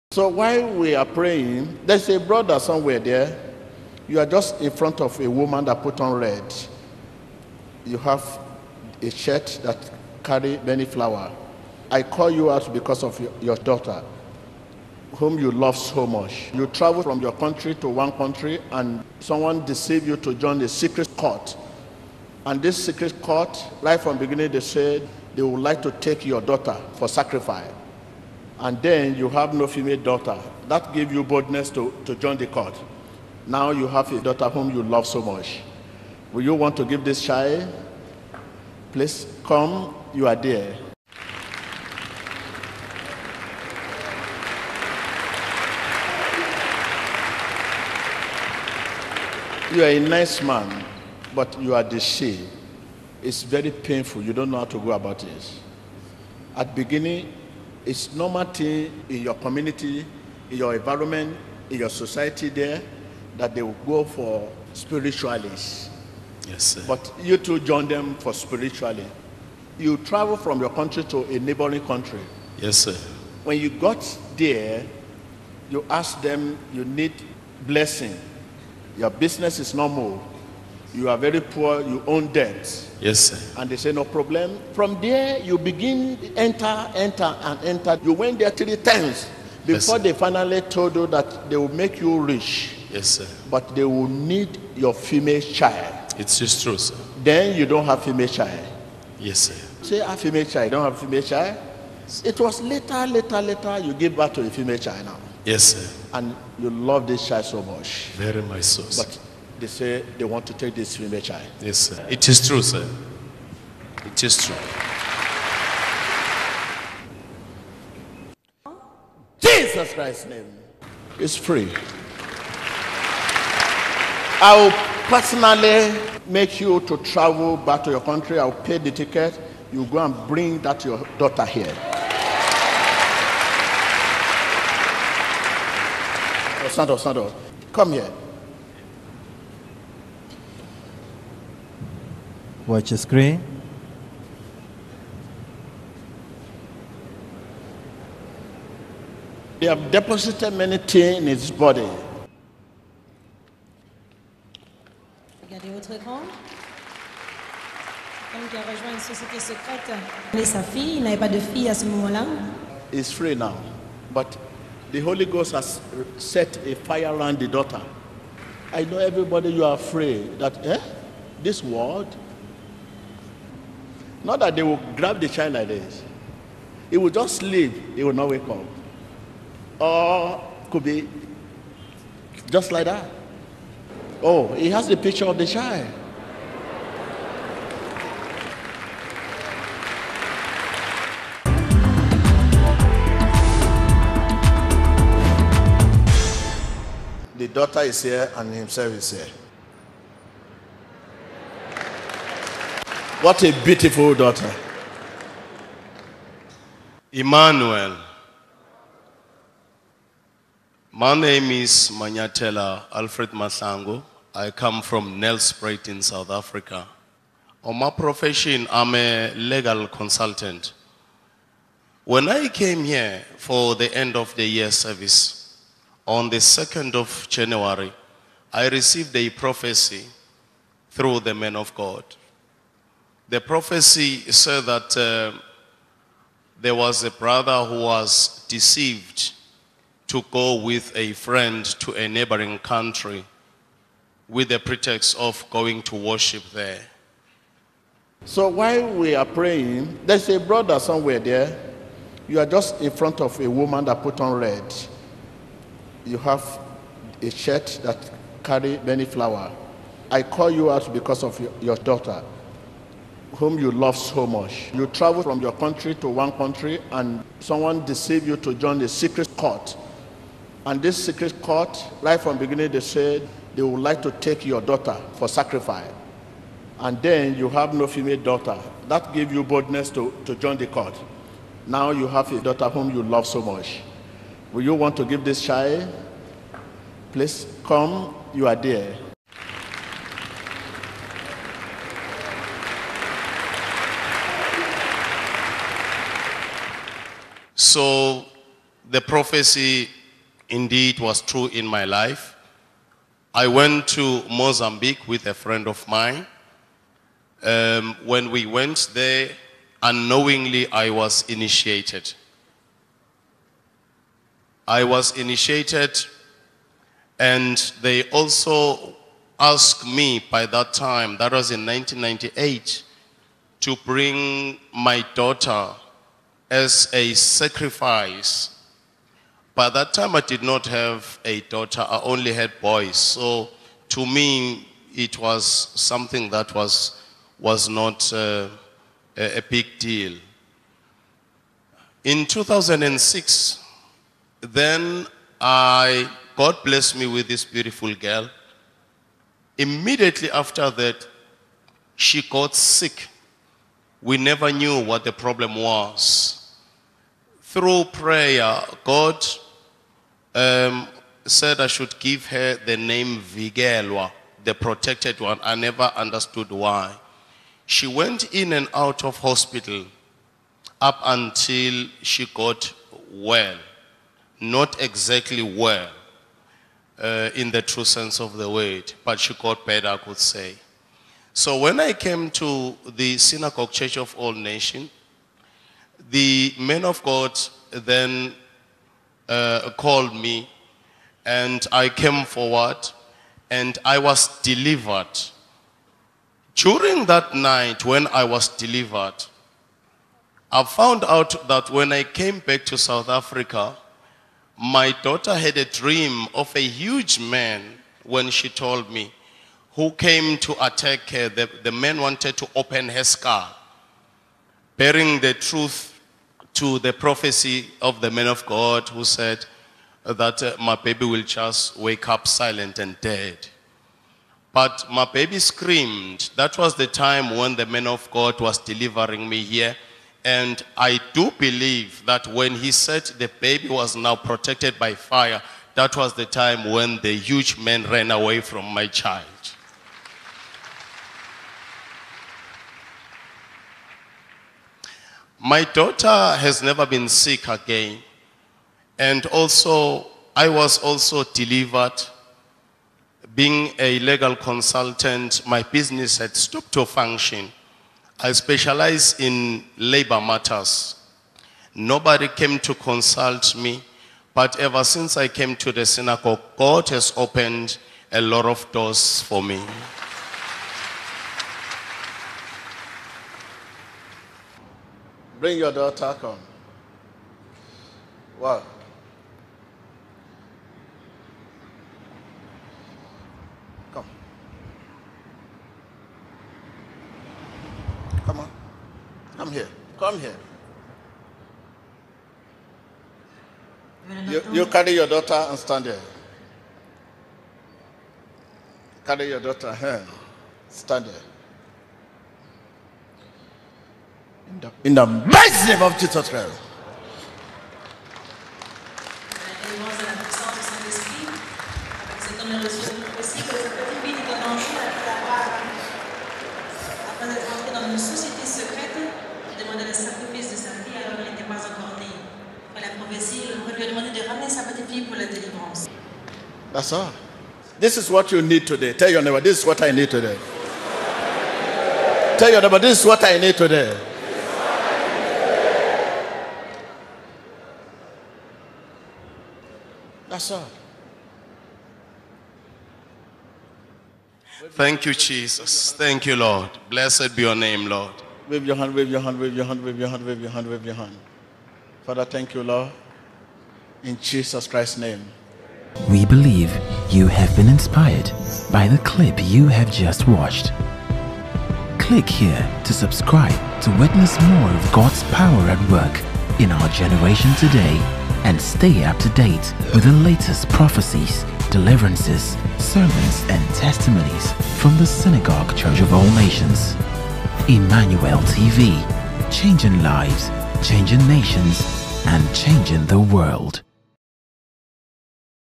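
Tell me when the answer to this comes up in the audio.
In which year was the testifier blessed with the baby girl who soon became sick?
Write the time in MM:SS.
05:42.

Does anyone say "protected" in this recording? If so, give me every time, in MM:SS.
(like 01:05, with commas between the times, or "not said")
06:04, 07:14.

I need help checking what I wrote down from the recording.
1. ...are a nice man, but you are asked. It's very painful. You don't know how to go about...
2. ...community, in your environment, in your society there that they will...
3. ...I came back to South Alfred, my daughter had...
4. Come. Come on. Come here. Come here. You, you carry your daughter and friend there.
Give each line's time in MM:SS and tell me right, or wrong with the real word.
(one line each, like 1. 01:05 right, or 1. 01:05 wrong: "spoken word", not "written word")
1. 00:49 wrong: "deceived", not "asked"
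2. 00:59 right
3. 06:41 wrong: "Africa", not "Alfred"
4. 08:03 wrong: "stand", not "friend".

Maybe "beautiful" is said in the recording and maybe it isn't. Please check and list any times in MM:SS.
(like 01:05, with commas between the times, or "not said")
03:23, 05:47.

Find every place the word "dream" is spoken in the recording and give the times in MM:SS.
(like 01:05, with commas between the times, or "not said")
06:45.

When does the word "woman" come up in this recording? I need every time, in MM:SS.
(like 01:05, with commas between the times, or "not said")
00:05, 04:13.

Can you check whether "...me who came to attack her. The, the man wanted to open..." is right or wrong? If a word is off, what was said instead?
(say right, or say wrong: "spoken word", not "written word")
right.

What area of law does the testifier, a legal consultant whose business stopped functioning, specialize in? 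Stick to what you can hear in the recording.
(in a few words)
Labor matters.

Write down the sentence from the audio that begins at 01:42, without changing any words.
Yes, it was later, later, later, you give birth to a female child now.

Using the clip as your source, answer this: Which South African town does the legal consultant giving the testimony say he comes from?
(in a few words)
Nelspruit.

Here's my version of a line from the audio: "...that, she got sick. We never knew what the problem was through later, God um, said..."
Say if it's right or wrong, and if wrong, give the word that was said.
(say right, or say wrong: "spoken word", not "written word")
wrong: "prayer", not "later".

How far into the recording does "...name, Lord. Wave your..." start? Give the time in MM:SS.
09:07.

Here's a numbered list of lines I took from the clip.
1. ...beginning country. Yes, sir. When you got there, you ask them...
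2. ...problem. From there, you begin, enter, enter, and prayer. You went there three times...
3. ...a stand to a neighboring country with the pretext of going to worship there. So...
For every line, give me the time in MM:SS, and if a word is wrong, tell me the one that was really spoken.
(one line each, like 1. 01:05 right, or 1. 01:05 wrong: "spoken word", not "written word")
1. 01:11 wrong: "neighboring", not "beginning"
2. 01:24 wrong: "enter", not "prayer"
3. 04:00 wrong: "friend", not "stand".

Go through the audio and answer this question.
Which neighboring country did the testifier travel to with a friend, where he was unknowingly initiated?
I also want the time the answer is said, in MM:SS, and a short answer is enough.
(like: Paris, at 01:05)
Mozambique, at 05:04.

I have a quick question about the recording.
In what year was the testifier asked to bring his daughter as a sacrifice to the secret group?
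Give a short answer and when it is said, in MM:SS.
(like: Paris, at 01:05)
1998, at 05:21.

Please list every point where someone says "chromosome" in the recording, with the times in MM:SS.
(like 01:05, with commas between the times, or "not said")
not said.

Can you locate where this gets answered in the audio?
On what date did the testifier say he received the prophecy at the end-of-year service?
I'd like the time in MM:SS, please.
03:46.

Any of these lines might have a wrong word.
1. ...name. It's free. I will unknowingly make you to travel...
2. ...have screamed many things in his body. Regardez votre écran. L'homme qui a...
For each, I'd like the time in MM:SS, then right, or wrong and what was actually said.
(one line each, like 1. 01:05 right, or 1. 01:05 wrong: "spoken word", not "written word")
1. 02:00 wrong: "personally", not "unknowingly"
2. 02:29 wrong: "deposited", not "screamed".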